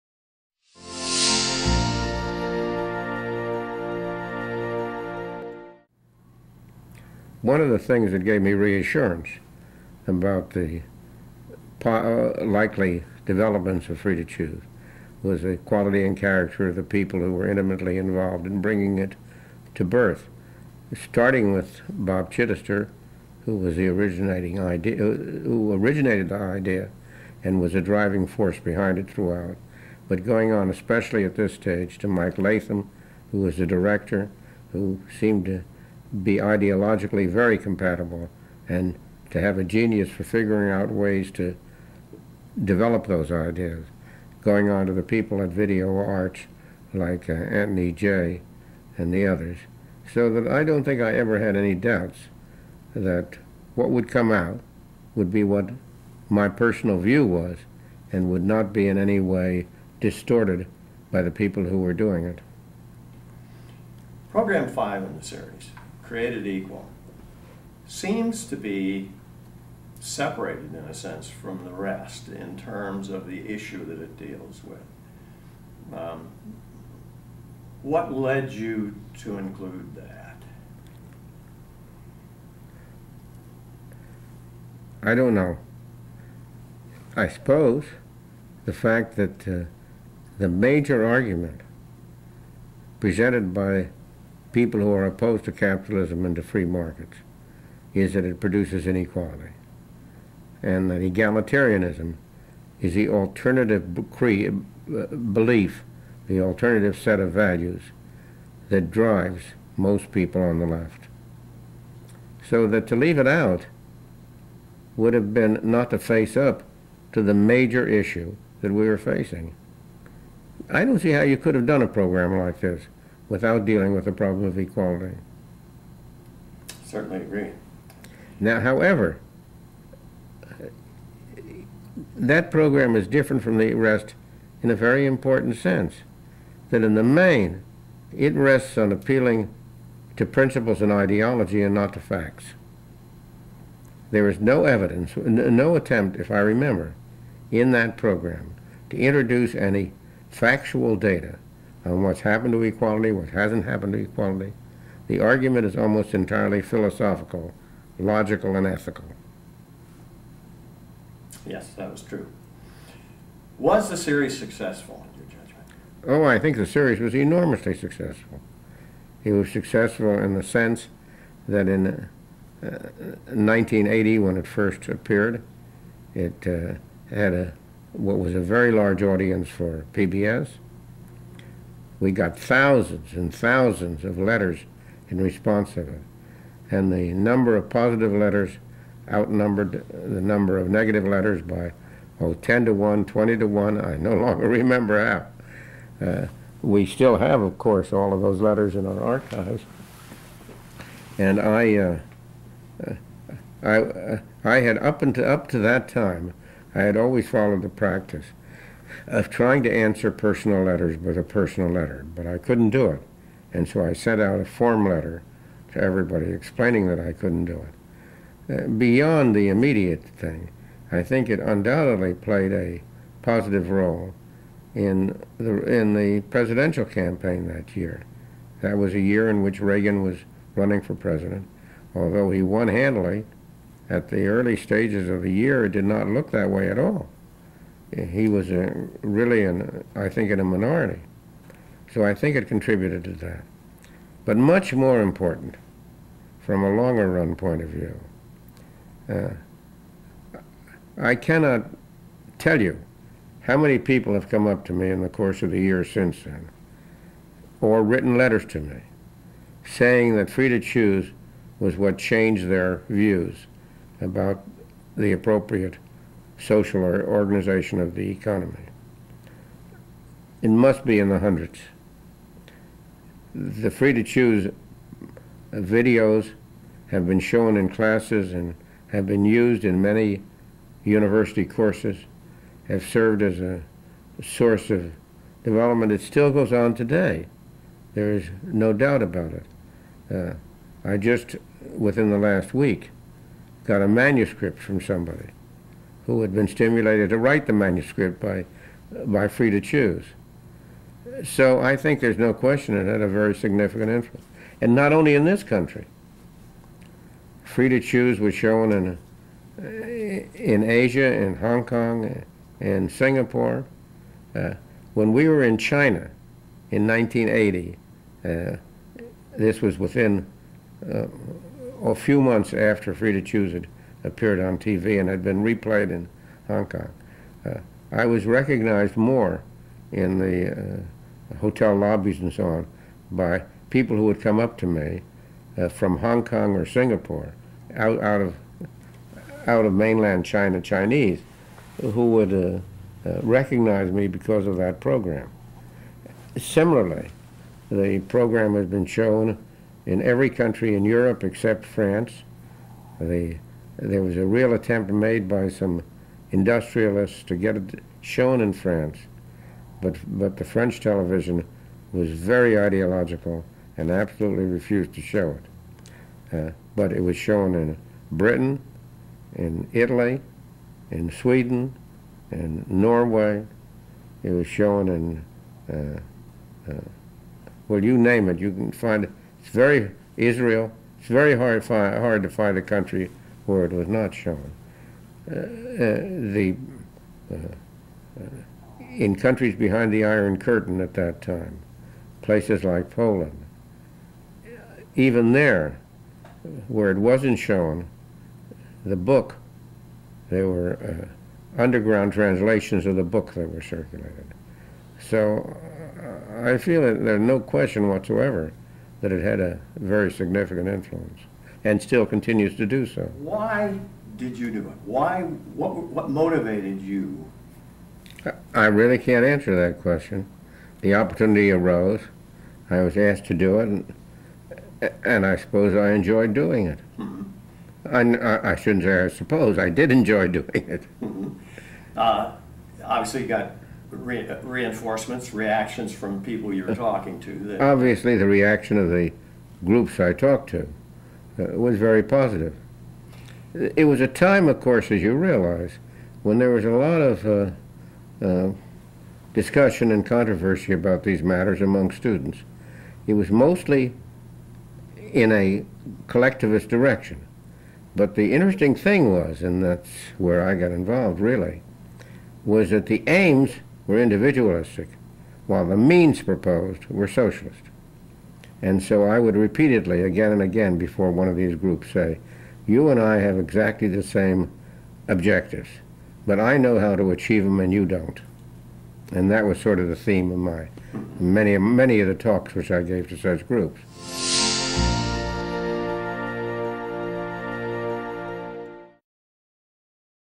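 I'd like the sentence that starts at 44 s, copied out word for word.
Going on to the people at Video Arts like uh, Anthony Jay and the others.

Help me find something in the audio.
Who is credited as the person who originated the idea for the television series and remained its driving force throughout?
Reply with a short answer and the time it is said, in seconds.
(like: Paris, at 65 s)
Bob Chitester, at 21 s.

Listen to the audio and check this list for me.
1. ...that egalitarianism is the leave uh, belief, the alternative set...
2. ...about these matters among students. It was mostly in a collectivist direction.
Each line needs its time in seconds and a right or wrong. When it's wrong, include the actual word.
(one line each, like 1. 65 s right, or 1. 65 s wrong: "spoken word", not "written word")
1. 100 s wrong: "alternative", not "leave"
2. 450 s right.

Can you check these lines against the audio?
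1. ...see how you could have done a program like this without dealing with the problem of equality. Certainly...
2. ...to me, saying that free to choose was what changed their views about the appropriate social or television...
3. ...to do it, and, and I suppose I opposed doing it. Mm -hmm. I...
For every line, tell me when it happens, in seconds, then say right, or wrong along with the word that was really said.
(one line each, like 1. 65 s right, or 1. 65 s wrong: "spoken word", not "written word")
1. 120 s right
2. 258 s wrong: "organization", not "television"
3. 423 s wrong: "enjoyed", not "opposed".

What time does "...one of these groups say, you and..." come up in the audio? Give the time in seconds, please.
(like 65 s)
471 s.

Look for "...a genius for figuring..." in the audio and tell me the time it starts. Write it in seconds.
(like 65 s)
39 s.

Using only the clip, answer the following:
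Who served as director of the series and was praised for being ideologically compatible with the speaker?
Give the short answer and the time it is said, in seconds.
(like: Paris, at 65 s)
Mike Latham, at 32 s.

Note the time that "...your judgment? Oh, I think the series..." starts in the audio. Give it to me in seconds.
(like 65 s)
165 s.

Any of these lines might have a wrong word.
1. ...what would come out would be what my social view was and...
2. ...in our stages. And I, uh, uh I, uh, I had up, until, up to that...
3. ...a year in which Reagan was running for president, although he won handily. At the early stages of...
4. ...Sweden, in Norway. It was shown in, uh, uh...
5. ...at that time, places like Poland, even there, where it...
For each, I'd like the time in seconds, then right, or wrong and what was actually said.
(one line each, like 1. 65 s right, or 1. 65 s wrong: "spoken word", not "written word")
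1. 53 s wrong: "personal", not "social"
2. 198 s wrong: "archives", not "stages"
3. 228 s right
4. 371 s right
5. 390 s right.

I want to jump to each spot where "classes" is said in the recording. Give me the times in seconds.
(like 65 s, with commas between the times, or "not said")
277 s.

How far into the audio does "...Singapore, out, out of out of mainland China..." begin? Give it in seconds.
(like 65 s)
336 s.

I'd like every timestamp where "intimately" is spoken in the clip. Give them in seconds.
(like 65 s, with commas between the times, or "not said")
17 s.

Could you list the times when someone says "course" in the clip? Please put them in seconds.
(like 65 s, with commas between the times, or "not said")
197 s, 255 s, 281 s, 444 s.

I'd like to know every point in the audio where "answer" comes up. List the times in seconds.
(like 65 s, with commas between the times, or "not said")
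209 s, 419 s.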